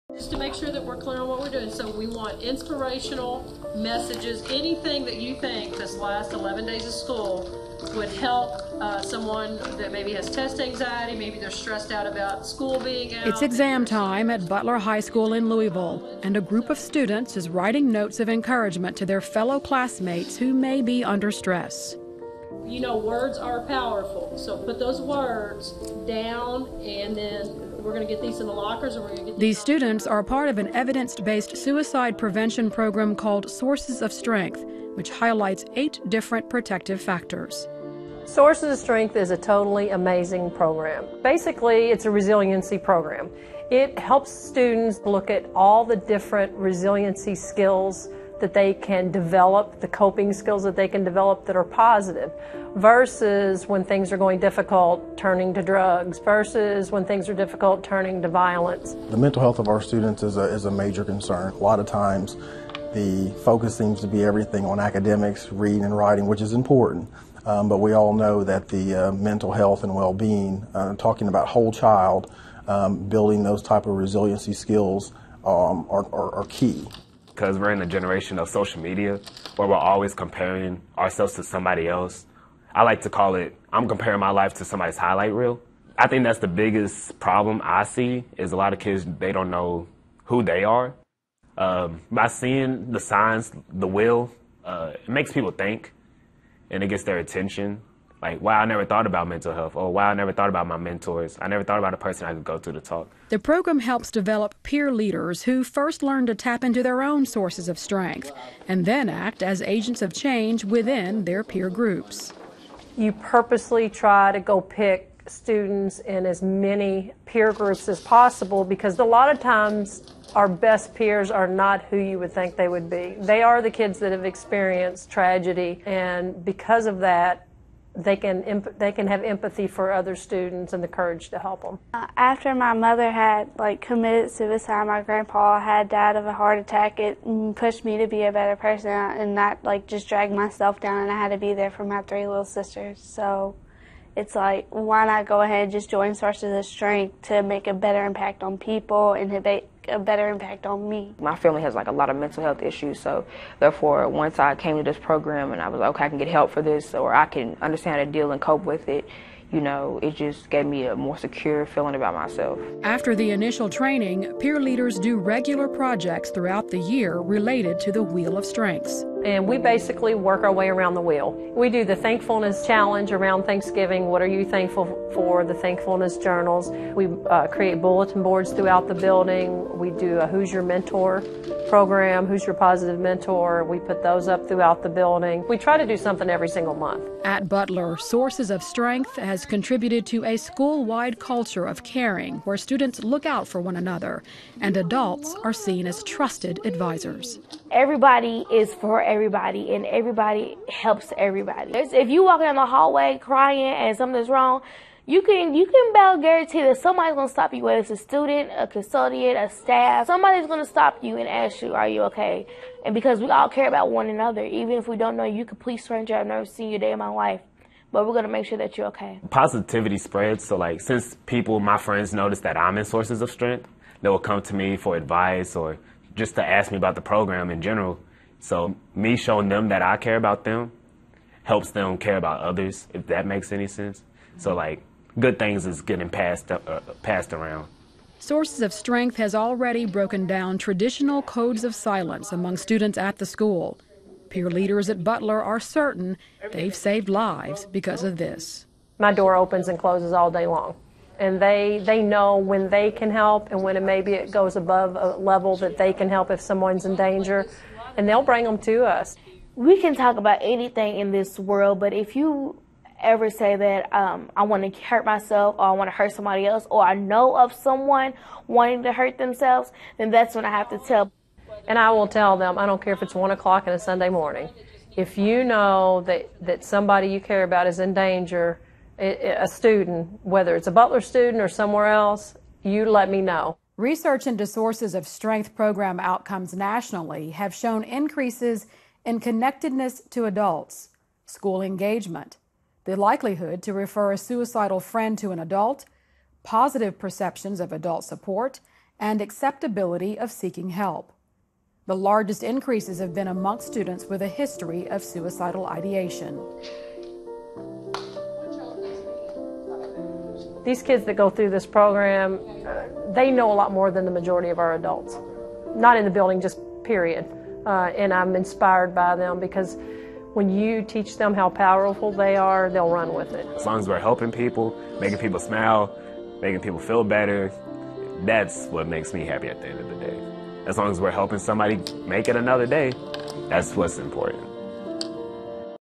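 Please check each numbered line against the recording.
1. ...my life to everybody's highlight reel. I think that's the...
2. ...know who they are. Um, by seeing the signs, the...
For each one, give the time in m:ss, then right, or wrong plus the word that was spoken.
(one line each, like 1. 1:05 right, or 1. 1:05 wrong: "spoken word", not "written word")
1. 1:24 wrong: "somebody", not "everybody"
2. 1:29 right.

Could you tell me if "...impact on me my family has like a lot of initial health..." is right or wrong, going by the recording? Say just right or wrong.
wrong.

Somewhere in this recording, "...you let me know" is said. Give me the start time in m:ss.
4:42.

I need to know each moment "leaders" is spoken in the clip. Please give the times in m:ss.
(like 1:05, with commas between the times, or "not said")
1:44, 2:44, 4:04.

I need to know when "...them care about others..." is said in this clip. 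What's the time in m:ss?
3:51.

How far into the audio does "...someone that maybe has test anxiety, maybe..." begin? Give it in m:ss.
0:09.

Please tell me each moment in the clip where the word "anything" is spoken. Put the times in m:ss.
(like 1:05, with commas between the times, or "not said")
0:04, 4:20.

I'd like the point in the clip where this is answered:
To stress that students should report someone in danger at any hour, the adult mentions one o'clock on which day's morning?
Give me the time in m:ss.
4:33.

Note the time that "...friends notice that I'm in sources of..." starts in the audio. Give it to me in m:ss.
3:41.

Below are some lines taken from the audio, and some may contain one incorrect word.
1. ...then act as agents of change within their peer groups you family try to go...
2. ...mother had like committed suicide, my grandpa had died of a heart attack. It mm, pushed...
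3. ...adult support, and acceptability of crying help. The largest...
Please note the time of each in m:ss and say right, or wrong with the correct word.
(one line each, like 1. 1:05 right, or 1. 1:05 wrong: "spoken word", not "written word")
1. 1:48 wrong: "purposely", not "family"
2. 2:12 right
3. 4:57 wrong: "seeking", not "crying".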